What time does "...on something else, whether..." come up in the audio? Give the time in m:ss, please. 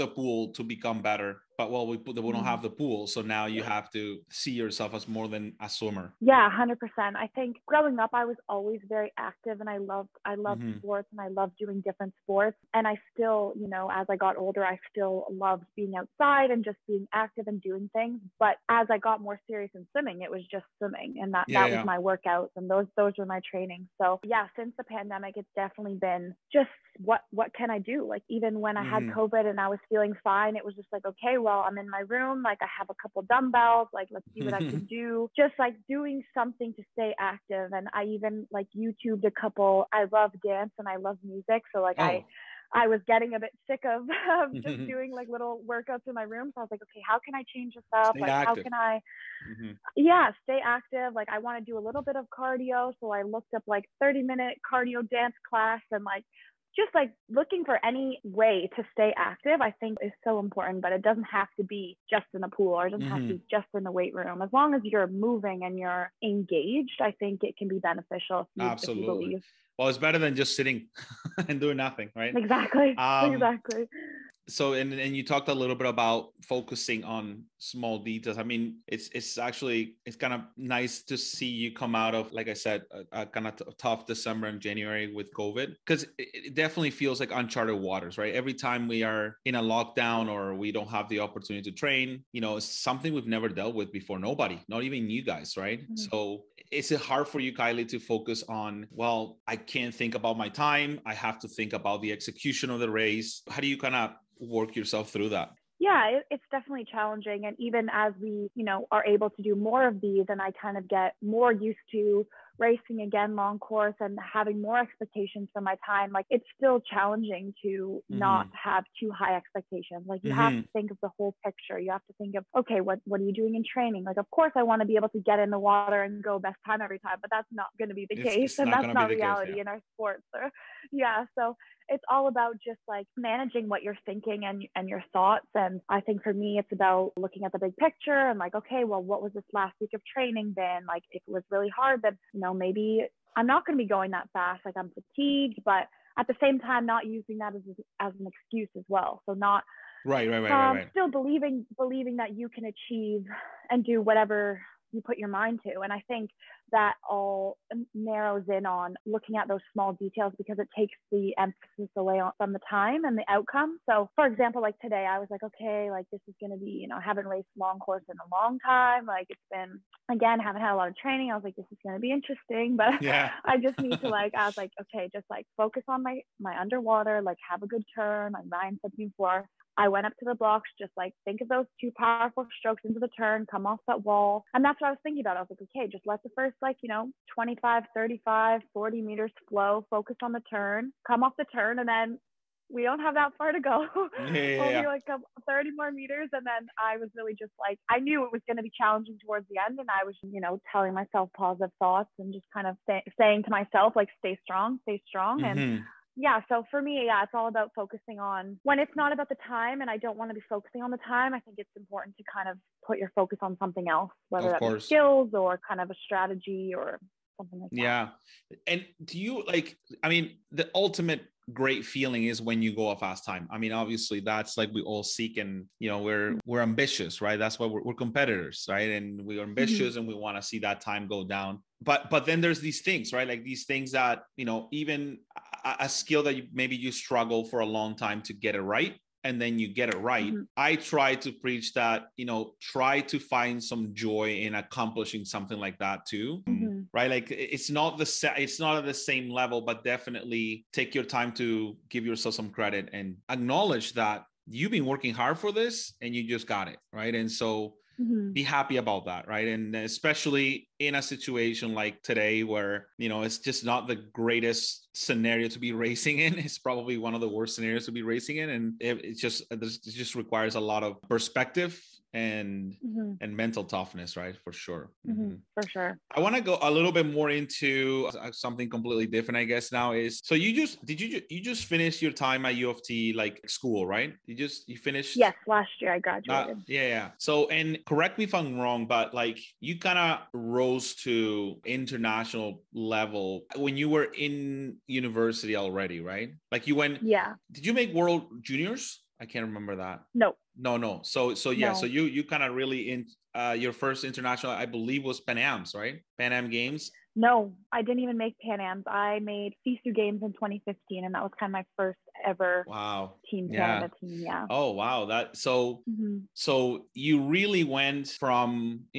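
3:33.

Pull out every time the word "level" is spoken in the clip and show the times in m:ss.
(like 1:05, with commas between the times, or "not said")
4:09, 4:52.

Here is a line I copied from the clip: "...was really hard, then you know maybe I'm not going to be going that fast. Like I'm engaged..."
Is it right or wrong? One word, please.
wrong.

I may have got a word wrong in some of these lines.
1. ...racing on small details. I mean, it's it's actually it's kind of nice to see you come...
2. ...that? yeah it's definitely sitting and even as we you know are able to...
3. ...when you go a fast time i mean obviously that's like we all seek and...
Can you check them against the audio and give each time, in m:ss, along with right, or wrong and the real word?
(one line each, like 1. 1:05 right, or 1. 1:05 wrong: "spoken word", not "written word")
1. 1:16 wrong: "focusing", not "racing"
2. 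1:45 wrong: "challenging", not "sitting"
3. 3:42 right.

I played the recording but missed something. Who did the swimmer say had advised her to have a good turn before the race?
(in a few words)
Ryan.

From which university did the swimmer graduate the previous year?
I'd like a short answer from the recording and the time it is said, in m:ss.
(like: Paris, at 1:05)
U of T, at 4:42.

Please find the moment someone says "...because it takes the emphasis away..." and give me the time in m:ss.
2:40.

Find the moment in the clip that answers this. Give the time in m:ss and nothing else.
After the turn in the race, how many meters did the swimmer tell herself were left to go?
3:15.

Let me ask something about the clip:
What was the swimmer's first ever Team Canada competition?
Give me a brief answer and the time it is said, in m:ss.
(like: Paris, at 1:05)
FISU Games, at 5:09.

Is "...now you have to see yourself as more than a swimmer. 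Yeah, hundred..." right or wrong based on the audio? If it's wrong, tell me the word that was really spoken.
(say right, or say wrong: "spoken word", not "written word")
right.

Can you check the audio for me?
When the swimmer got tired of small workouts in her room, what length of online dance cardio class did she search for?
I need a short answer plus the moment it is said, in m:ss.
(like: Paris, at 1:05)
30 minutes, at 0:54.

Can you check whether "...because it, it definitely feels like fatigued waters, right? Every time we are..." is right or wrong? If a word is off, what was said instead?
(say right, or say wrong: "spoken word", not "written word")
wrong: "uncharted", not "fatigued".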